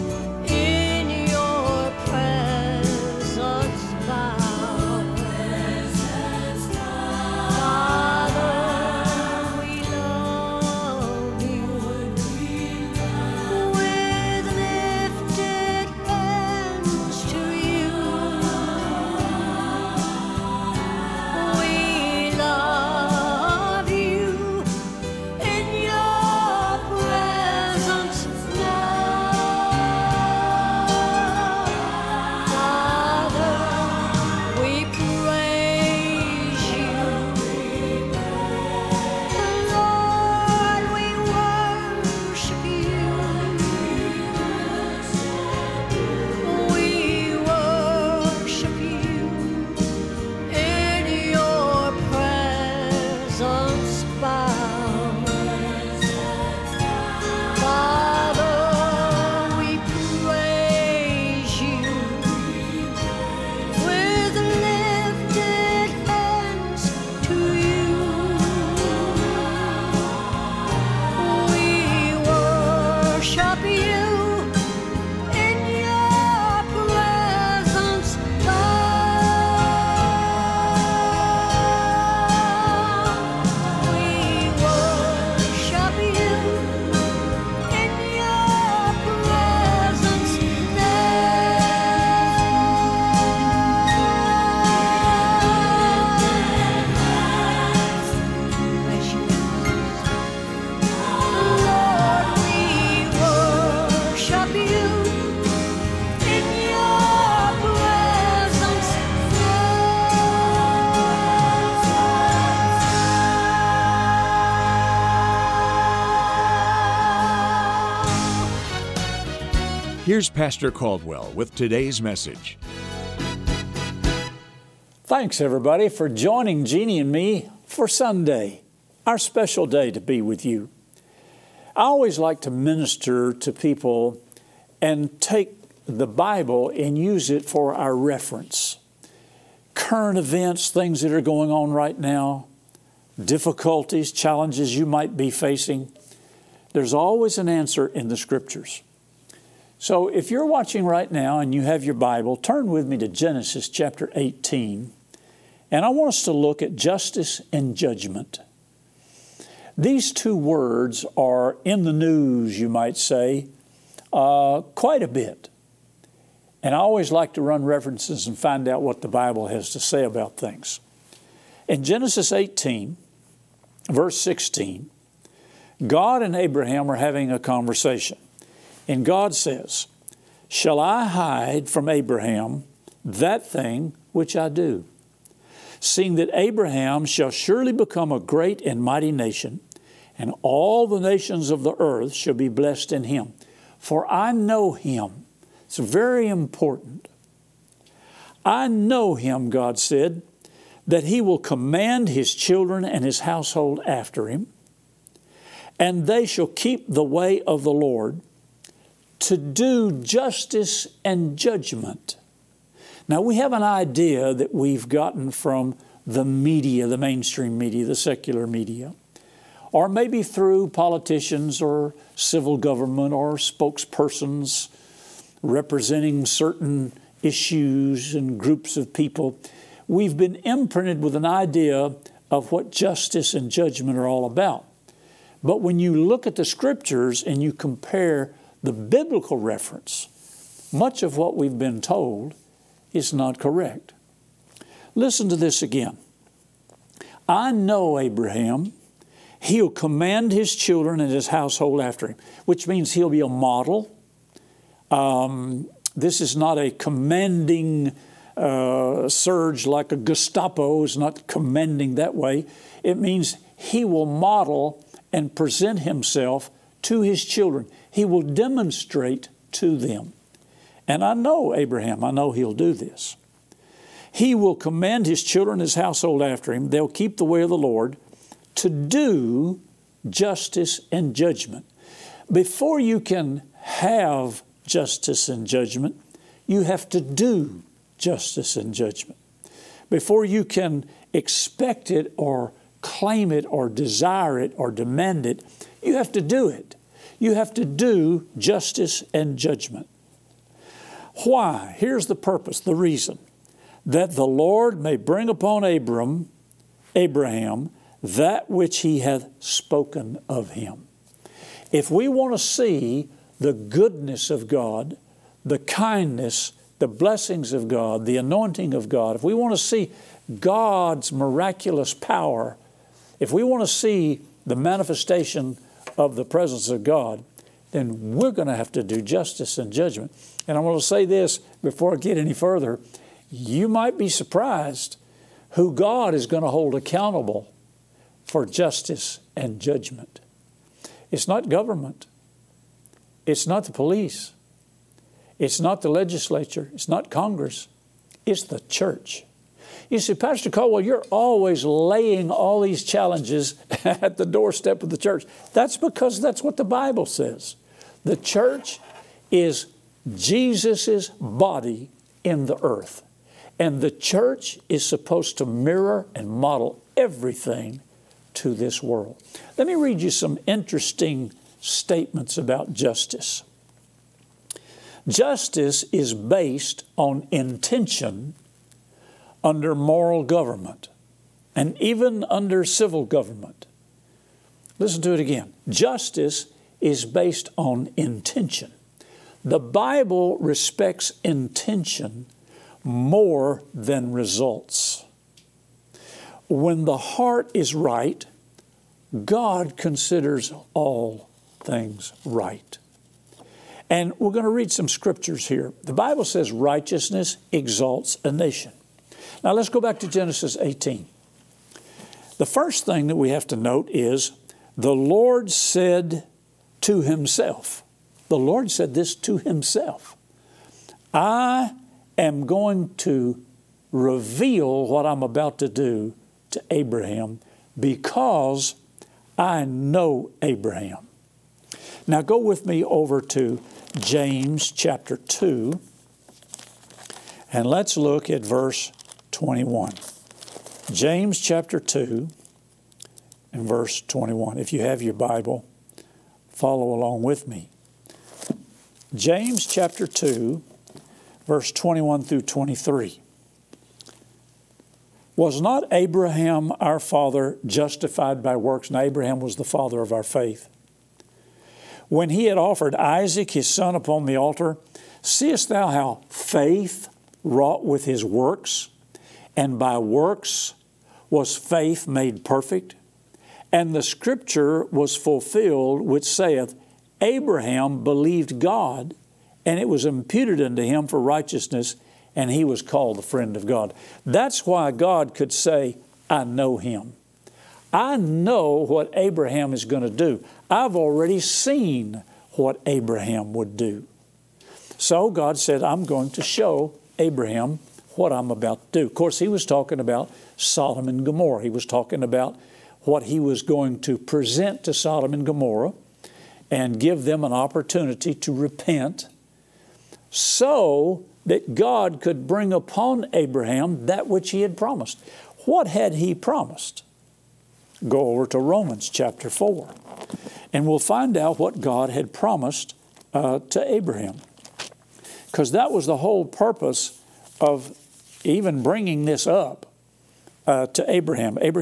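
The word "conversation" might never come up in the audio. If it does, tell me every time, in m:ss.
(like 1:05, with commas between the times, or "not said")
2:57.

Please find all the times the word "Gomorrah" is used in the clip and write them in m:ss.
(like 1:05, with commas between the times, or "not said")
8:21, 8:25.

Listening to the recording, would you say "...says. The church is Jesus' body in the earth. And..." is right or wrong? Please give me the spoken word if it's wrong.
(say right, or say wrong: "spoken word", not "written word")
right.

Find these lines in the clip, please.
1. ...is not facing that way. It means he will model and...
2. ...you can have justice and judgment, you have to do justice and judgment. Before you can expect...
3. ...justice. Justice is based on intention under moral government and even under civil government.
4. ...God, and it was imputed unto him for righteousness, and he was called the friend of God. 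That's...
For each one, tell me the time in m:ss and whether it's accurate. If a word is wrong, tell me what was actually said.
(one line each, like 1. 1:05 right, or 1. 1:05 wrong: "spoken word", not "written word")
1. 4:20 wrong: "commanding", not "facing"
2. 4:42 right
3. 6:12 right
4. 7:58 right.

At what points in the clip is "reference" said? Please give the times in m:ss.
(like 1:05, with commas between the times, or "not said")
2:17, 2:47, 3:59.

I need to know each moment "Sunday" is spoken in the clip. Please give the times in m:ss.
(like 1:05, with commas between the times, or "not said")
2:07.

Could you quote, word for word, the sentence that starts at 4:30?
And I know Abraham, I know he'll do this.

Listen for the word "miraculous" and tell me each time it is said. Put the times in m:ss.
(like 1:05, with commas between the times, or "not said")
5:21.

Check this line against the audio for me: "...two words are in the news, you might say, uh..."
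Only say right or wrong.
right.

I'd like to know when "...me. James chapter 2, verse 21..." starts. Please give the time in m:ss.
7:27.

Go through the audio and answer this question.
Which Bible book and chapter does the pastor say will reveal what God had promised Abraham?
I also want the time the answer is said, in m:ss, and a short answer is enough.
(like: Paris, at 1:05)
Romans 4, at 8:38.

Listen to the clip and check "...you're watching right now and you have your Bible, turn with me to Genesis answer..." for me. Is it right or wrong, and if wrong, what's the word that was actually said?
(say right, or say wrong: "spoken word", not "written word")
wrong: "chapter", not "answer".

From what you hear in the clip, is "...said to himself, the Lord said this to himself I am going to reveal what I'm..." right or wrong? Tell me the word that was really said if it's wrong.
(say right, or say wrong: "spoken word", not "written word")
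right.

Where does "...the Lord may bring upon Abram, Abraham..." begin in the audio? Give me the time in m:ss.
5:04.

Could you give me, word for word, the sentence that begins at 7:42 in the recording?
When he had offered Isaac his son upon the altar, seest thou how faith wrought with his works?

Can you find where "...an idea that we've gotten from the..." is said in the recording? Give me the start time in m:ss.
3:33.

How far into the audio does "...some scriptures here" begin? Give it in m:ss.
6:44.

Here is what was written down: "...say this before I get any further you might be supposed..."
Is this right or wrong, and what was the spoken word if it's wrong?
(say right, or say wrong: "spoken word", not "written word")
wrong: "surprised", not "supposed".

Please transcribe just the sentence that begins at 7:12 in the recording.
Now go with me over to James chapter 2 and let's look at verse 21.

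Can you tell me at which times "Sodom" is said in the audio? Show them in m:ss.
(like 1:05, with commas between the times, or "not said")
8:20, 8:24.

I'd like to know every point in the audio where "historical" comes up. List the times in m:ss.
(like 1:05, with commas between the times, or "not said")
not said.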